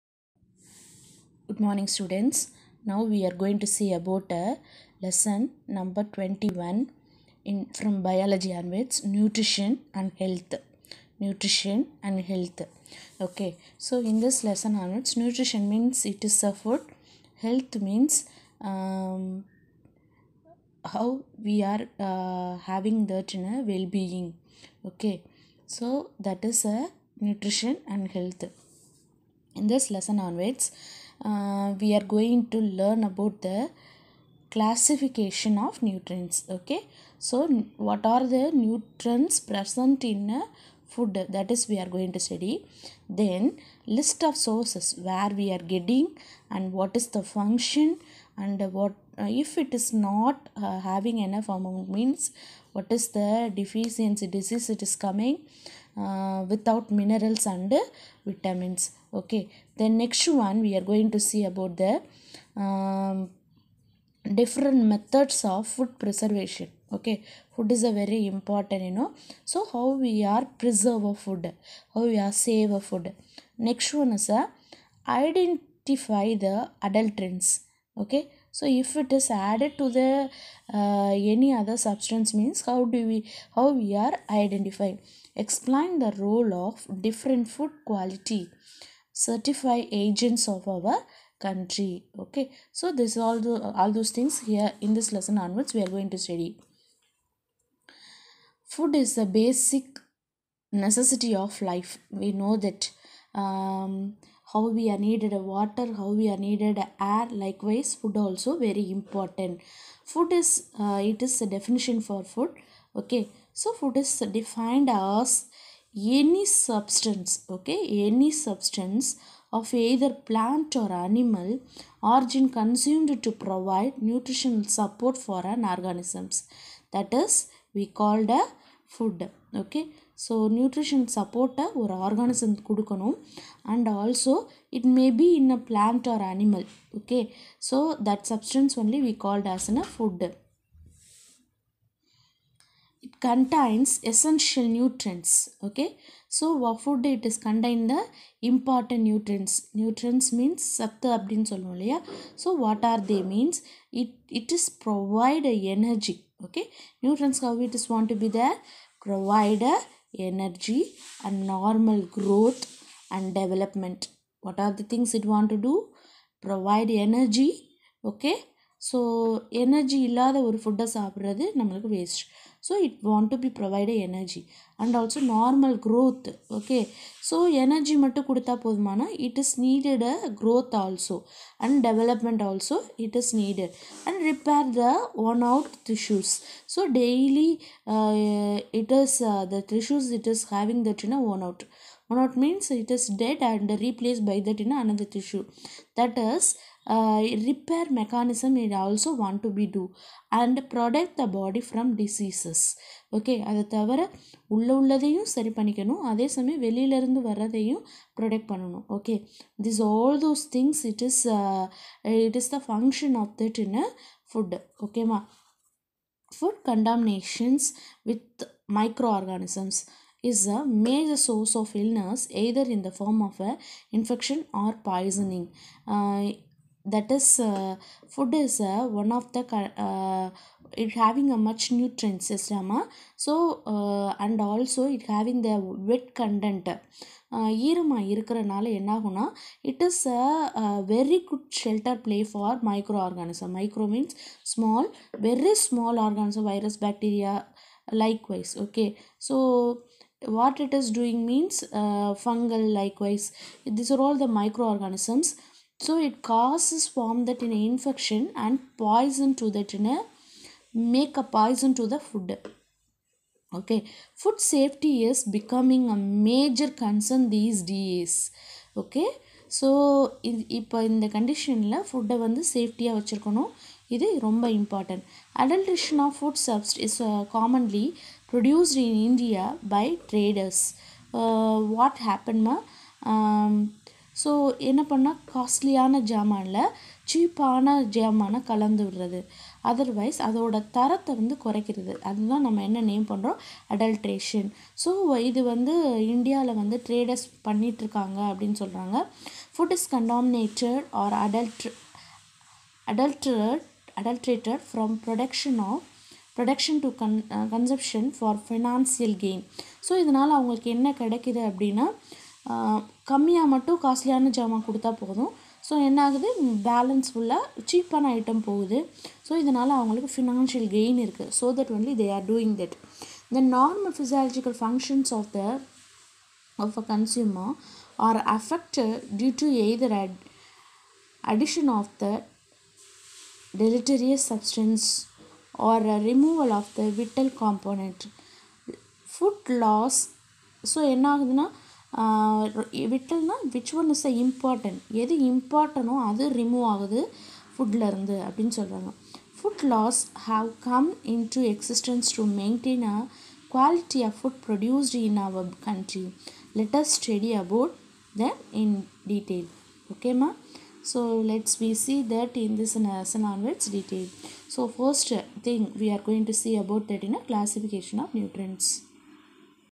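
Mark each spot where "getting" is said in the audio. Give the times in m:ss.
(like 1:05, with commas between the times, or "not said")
0:45.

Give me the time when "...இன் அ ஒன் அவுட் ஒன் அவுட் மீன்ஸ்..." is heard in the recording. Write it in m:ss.
3:11.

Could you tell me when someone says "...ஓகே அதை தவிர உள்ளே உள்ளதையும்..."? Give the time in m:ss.
3:23.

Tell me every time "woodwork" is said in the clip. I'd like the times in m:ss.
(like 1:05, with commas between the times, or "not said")
not said.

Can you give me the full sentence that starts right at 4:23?
Okay, food safety is becoming a major concern these days.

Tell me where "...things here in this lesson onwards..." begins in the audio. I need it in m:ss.
1:34.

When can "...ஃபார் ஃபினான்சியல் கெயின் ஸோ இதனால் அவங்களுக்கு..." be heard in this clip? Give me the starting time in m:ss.
5:08.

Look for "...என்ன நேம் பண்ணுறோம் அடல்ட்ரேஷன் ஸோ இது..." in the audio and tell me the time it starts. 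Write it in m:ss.
4:52.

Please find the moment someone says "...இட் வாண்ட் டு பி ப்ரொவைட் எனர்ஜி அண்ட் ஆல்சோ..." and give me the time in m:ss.
2:52.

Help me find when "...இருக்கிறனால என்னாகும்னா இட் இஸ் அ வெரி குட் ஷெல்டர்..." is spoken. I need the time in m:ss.
3:58.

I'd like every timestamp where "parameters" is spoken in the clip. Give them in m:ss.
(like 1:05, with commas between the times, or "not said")
not said.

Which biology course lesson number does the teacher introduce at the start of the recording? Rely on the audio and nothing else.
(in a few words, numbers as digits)
21.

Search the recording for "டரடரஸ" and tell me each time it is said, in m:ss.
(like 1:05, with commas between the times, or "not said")
4:40, 4:56.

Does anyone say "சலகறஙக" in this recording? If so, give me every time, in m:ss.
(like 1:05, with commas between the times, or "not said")
4:58, 5:48.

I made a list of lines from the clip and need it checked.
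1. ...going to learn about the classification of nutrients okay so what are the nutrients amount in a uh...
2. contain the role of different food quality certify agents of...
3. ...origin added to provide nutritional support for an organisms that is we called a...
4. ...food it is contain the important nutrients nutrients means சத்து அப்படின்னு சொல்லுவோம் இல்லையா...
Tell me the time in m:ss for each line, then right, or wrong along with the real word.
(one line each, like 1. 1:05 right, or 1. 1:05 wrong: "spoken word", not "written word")
1. 0:32 wrong: "present", not "amount"
2. 1:25 wrong: "explain", not "contain"
3. 2:02 wrong: "consumed", not "added"
4. 2:26 right.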